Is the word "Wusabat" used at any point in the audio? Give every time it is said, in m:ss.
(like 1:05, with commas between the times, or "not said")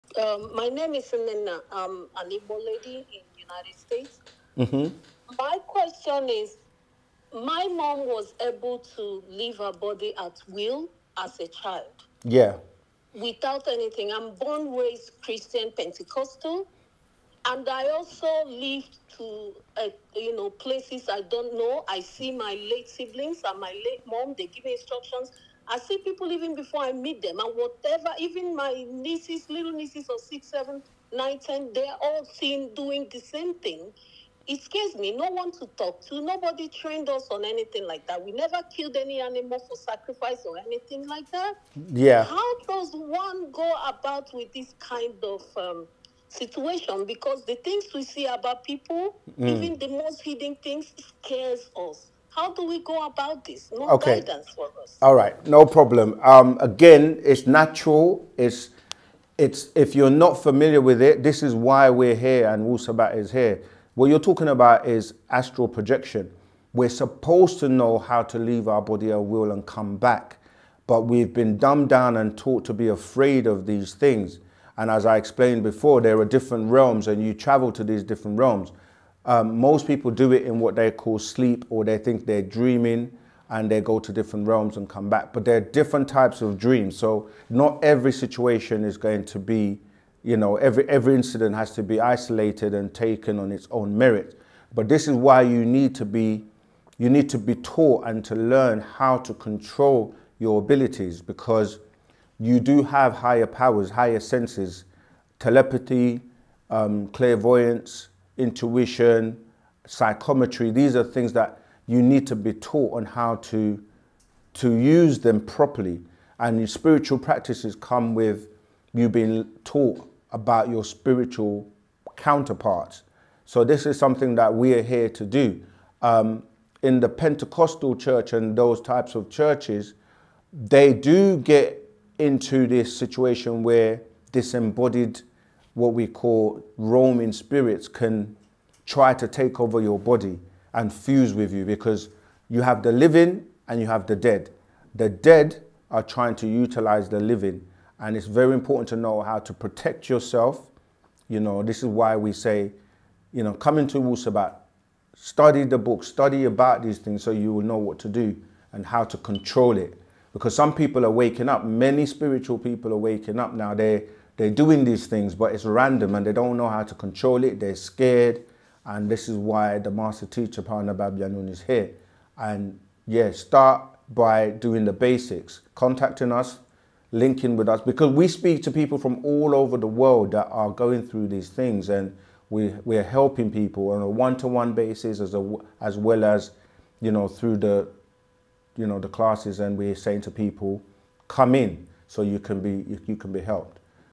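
1:02, 2:33.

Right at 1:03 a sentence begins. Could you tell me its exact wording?
What you're talking about is astral projection.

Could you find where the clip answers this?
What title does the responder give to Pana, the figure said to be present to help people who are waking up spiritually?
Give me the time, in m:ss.
2:49.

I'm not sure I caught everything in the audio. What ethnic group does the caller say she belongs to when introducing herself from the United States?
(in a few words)
Igbo.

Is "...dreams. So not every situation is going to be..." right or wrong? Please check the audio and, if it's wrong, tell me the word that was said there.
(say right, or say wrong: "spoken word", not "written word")
right.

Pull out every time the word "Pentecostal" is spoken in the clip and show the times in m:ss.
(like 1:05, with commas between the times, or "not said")
0:15, 2:07.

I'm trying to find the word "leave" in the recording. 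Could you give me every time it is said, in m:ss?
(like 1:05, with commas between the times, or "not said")
0:09, 1:08.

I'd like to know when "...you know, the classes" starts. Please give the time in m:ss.
3:08.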